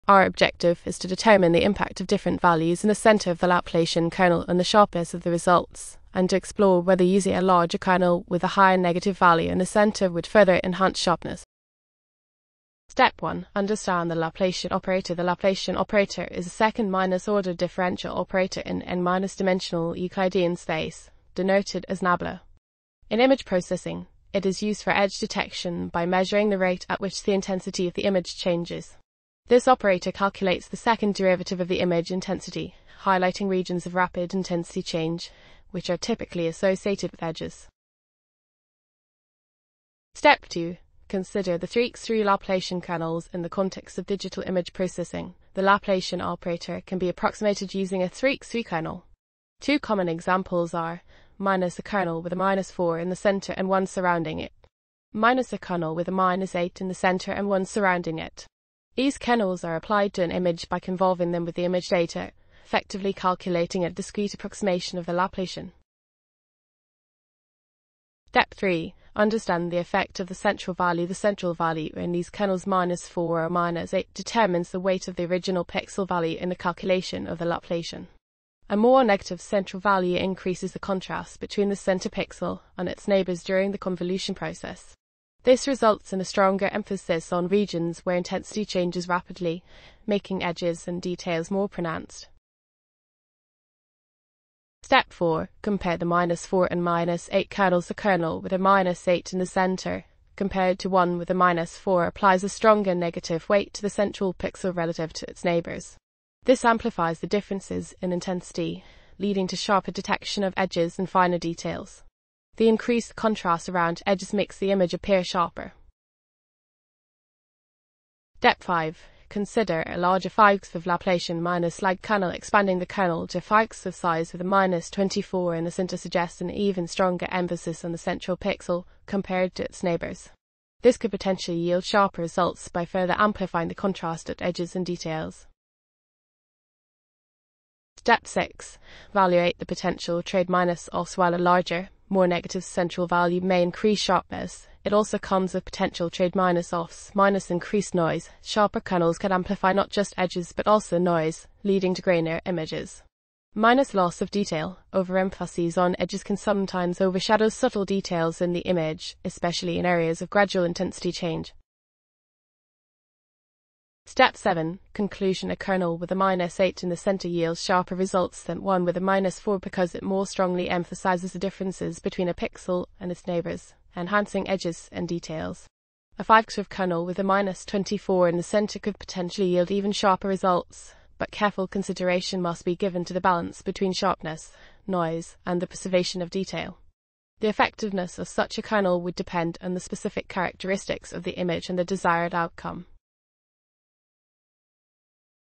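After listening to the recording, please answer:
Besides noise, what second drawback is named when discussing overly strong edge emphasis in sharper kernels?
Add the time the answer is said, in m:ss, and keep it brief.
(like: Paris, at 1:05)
Loss of detail, at 2:33.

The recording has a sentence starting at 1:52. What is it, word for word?
The increased contrast around edges makes the image appear sharper.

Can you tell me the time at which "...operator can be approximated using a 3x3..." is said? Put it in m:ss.
0:46.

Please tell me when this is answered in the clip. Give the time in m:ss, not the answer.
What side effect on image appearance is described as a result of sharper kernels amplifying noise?
2:32.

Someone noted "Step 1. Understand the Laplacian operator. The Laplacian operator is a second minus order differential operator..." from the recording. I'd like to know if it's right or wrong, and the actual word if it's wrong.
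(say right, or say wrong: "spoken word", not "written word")
right.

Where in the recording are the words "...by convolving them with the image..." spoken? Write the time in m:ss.
1:00.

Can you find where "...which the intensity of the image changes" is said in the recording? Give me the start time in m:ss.
0:26.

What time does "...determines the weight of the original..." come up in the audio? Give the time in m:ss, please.
1:14.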